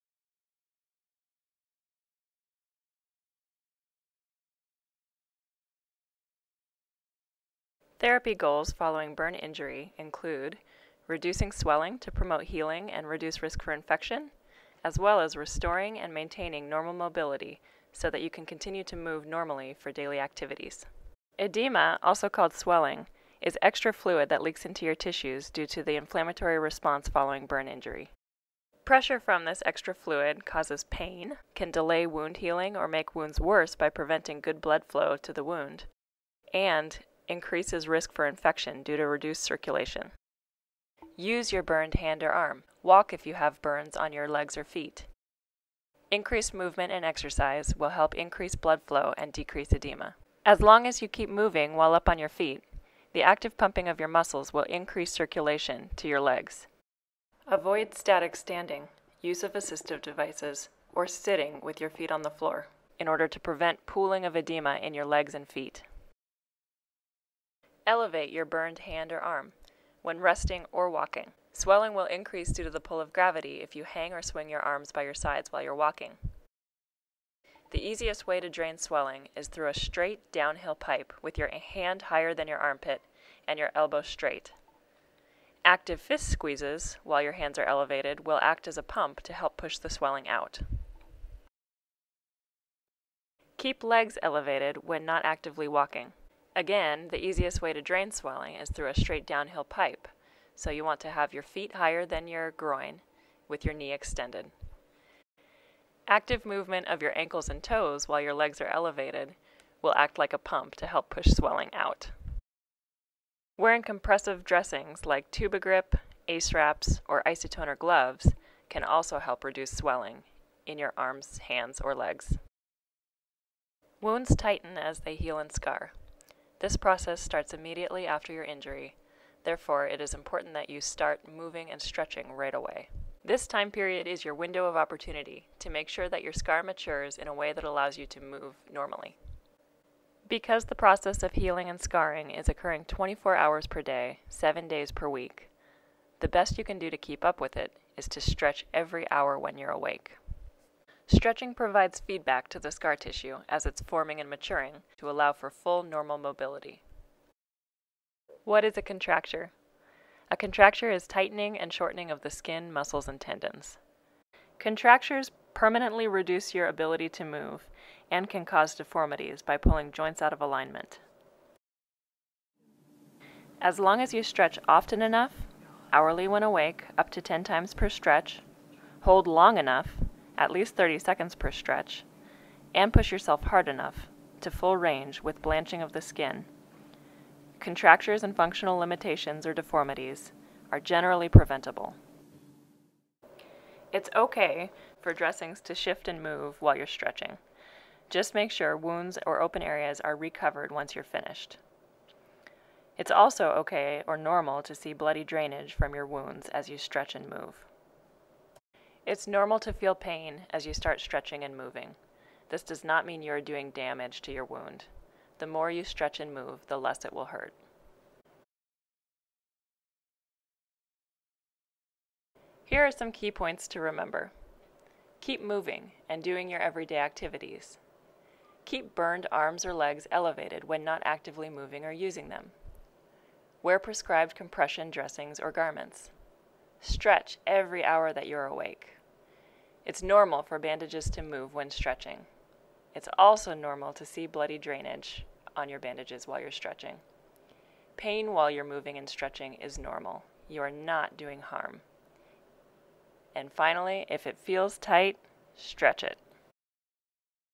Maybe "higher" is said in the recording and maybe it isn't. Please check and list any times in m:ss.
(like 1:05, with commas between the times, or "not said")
1:22, 1:41.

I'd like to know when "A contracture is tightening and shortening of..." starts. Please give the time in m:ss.
2:40.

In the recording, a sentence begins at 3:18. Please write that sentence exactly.
Just make sure wounds or open areas are recovered once you're finished.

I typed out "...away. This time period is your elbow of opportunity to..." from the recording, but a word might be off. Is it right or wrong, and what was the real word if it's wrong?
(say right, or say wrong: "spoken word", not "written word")
wrong: "window", not "elbow".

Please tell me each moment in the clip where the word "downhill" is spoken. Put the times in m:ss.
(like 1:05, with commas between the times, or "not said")
1:20, 1:39.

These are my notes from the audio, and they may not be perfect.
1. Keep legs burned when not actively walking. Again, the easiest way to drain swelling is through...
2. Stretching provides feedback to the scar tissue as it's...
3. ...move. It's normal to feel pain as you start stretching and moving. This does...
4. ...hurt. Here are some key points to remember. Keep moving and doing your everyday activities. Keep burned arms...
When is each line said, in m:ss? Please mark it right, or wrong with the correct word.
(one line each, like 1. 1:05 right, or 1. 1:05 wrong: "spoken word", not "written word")
1. 1:33 wrong: "elevated", not "burned"
2. 2:31 right
3. 3:27 right
4. 3:37 right.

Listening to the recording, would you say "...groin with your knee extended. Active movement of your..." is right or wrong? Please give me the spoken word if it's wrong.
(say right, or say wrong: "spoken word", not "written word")
right.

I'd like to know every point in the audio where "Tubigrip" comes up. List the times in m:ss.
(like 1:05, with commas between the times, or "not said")
1:55.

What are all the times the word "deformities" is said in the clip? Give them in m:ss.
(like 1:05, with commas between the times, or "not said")
2:48, 3:09.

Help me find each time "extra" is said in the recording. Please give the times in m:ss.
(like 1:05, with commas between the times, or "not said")
0:23, 0:29.